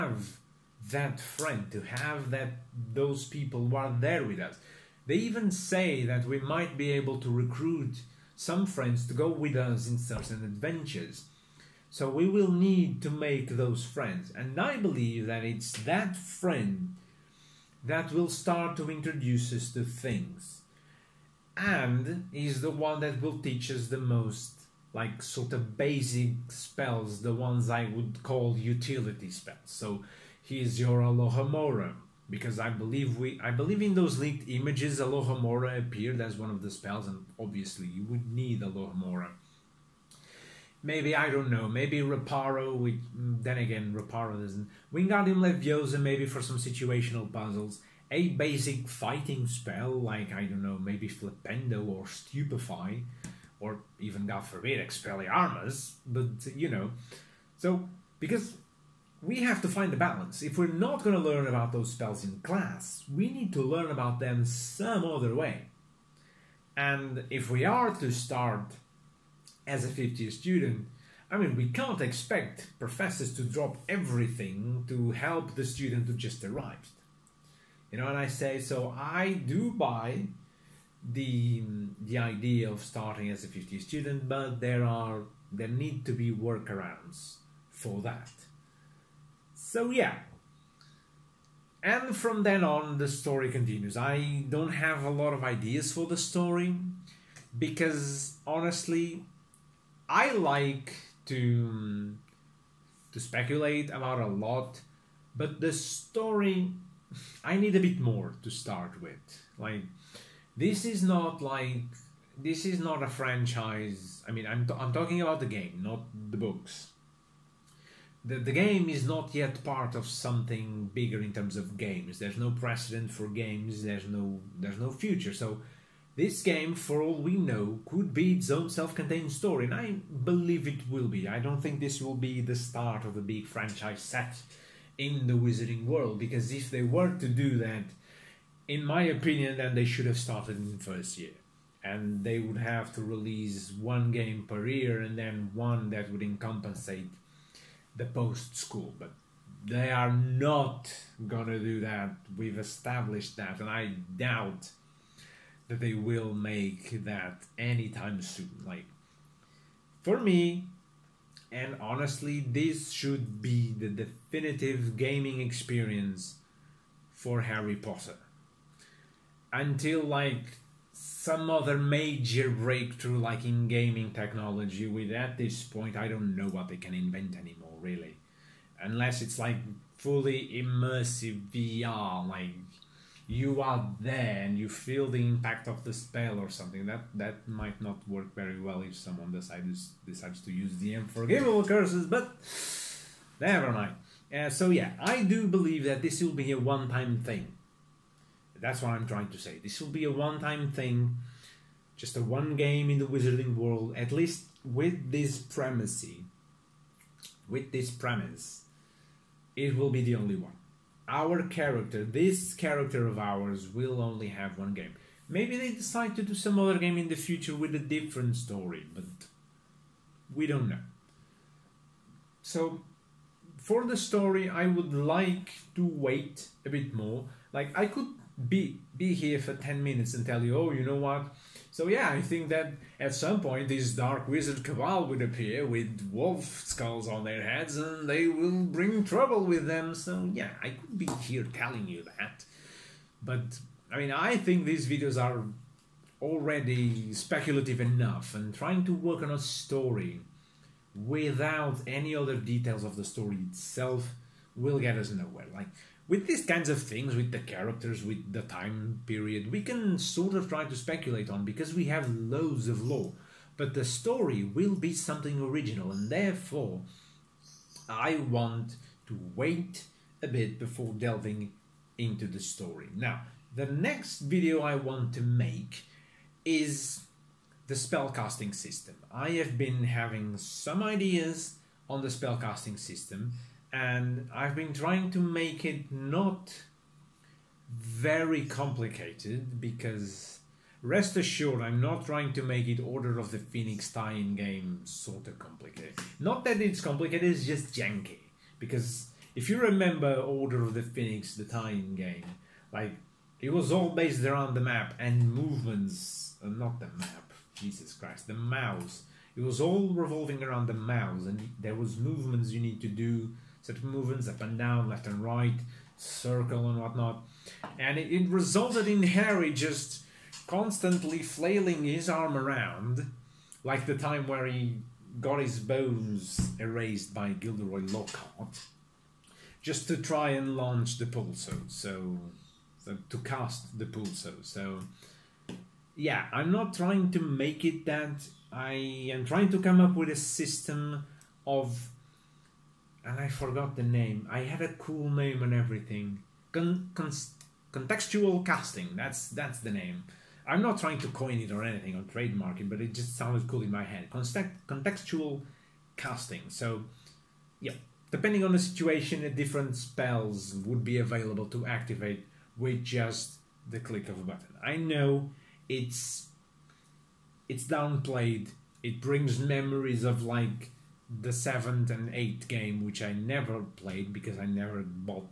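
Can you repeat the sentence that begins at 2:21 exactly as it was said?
And they would have to release one game per year and then one that would compensate the post school.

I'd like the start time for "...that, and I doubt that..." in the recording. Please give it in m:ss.
2:33.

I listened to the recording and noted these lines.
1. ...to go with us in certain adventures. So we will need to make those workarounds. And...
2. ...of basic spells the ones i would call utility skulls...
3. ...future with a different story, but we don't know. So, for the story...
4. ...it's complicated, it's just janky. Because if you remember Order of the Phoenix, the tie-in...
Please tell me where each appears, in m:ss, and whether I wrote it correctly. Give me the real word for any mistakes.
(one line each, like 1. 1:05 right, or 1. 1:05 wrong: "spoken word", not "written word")
1. 0:09 wrong: "friends", not "workarounds"
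2. 0:25 wrong: "spells", not "skulls"
3. 3:37 right
4. 4:56 right.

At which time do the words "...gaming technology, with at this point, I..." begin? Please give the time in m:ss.
2:53.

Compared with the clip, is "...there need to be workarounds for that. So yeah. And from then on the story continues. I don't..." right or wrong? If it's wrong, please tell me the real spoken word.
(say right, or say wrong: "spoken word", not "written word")
right.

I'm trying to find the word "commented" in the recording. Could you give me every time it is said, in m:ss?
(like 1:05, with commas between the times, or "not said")
not said.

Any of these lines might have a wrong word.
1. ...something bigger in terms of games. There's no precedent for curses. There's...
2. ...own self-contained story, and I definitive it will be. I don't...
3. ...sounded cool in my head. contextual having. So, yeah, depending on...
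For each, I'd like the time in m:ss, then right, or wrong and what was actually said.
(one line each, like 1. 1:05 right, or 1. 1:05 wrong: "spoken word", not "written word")
1. 2:00 wrong: "games", not "curses"
2. 2:08 wrong: "believe", not "definitive"
3. 5:53 wrong: "casting", not "having".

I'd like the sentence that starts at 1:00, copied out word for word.
If we're not going to learn about those spells in class, we need to learn about them some other way.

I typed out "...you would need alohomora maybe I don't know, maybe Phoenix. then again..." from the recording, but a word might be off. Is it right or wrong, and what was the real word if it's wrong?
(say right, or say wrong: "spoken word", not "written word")
wrong: "Reparo", not "Phoenix".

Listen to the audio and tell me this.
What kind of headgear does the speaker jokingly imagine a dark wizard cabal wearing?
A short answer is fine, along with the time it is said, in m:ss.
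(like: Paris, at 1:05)
Wolf skulls, at 3:56.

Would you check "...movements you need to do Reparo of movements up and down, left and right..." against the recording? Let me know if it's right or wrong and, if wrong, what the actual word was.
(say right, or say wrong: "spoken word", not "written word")
wrong: "Sort", not "Reparo".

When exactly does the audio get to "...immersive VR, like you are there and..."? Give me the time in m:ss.
3:00.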